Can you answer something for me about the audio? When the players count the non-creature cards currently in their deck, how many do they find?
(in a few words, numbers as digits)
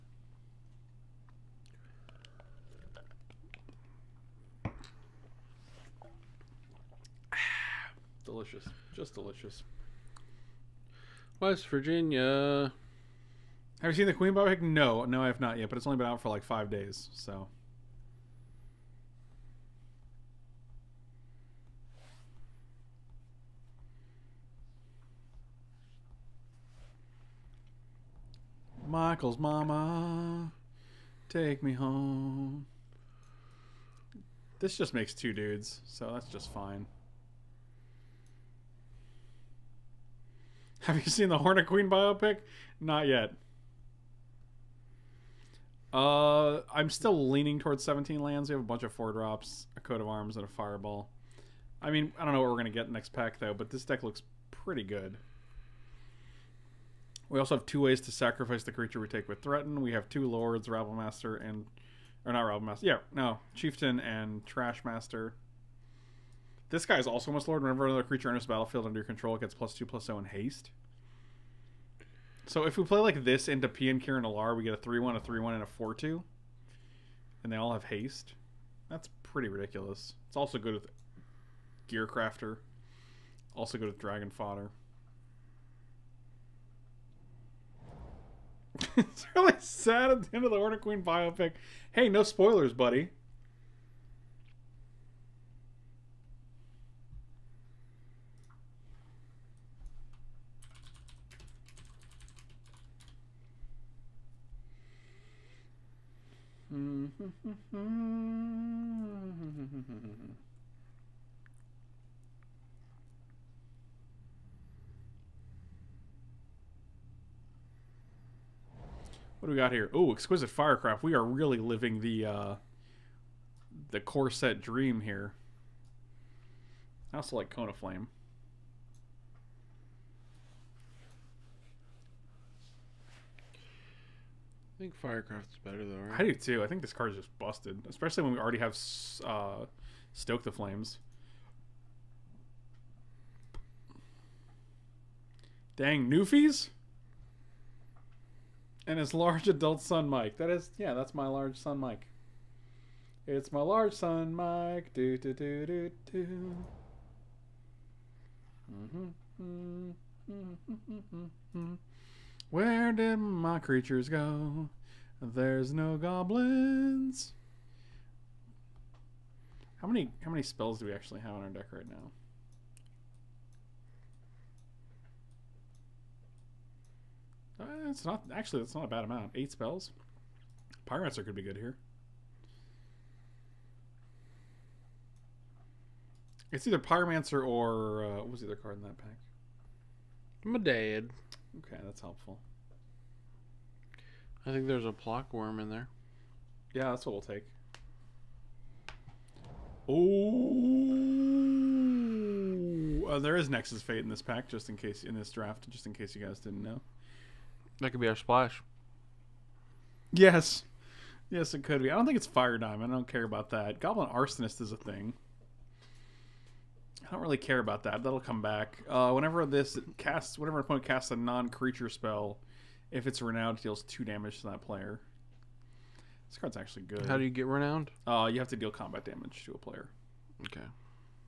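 8.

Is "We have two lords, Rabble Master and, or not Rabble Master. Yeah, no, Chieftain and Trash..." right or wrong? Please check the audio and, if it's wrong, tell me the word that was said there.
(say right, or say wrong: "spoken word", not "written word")
right.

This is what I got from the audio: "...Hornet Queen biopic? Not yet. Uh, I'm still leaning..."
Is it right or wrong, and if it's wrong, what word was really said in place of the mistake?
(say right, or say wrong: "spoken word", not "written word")
right.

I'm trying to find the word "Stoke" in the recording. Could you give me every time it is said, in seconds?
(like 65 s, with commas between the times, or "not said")
140 s.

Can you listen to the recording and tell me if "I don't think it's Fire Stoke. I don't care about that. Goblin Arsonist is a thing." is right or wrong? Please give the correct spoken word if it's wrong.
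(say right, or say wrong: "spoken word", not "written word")
wrong: "Diamond", not "Stoke".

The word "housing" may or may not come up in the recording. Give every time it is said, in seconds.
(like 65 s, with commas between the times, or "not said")
not said.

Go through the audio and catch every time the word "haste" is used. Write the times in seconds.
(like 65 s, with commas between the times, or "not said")
70 s, 77 s.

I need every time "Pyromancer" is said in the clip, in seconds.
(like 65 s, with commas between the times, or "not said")
180 s, 186 s.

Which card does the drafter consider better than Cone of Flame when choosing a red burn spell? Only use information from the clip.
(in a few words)
Exquisite Firecraft.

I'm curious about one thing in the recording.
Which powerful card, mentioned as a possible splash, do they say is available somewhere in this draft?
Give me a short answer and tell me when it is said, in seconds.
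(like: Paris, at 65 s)
Nexus Fate, at 203 s.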